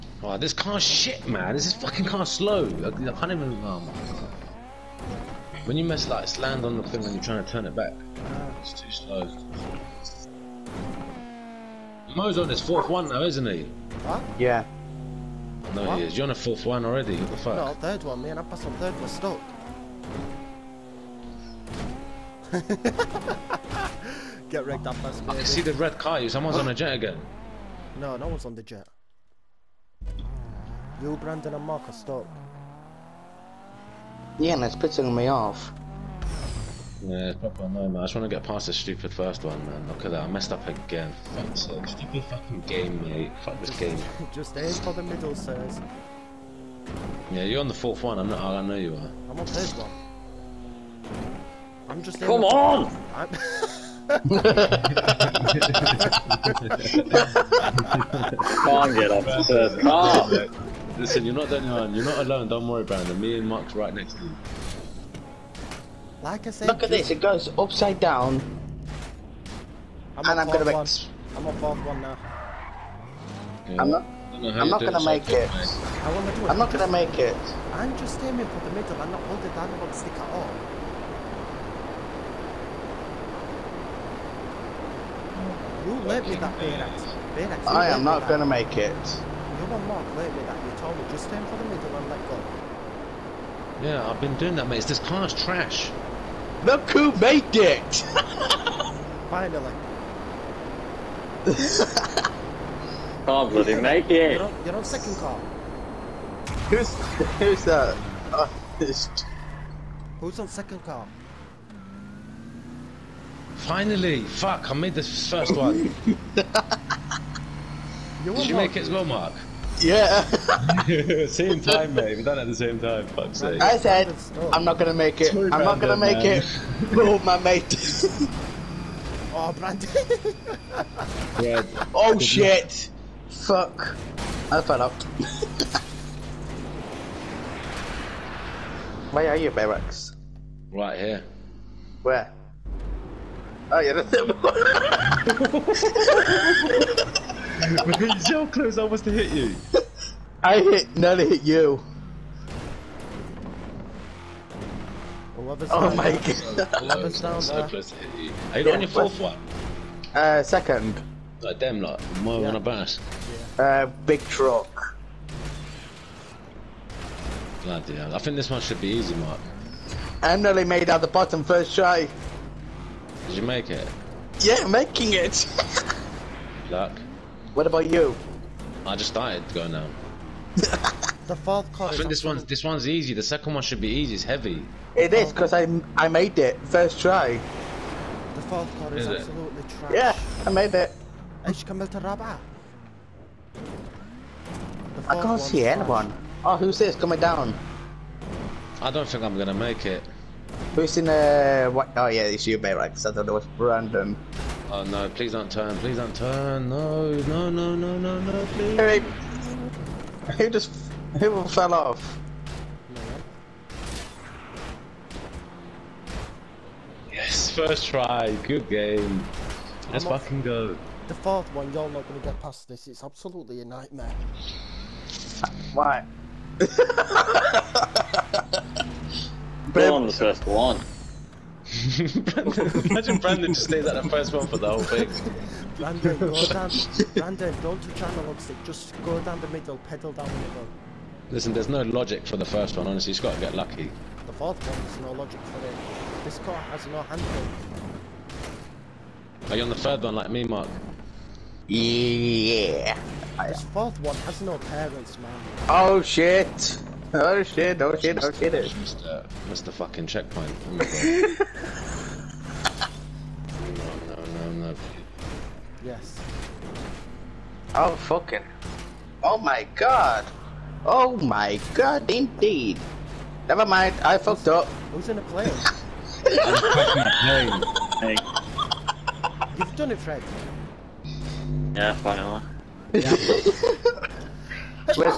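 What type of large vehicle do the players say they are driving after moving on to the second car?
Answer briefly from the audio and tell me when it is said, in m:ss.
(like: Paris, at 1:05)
big truck, at 2:44.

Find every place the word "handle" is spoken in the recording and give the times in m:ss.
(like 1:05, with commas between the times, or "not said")
4:07.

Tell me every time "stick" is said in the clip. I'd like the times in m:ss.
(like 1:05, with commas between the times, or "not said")
1:19, 3:58.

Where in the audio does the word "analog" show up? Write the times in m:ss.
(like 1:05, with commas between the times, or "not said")
3:58.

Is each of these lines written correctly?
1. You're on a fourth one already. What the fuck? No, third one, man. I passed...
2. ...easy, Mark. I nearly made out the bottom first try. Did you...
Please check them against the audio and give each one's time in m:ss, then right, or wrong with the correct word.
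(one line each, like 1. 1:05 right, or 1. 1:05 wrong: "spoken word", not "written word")
1. 0:16 right
2. 2:48 right.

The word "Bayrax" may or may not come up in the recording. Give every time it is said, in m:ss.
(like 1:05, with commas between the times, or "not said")
1:26, 3:22.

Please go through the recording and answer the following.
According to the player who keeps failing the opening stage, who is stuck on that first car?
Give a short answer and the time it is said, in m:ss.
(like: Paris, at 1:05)
Me and Mark, at 1:03.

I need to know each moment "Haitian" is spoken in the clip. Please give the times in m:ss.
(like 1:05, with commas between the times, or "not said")
not said.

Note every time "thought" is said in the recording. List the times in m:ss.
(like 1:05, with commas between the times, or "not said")
3:23.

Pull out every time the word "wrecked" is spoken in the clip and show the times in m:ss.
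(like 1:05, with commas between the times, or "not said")
0:24.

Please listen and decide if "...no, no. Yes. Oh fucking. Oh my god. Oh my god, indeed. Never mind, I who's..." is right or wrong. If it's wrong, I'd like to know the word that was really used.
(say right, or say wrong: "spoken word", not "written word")
right.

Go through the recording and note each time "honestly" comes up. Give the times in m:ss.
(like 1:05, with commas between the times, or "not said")
4:02.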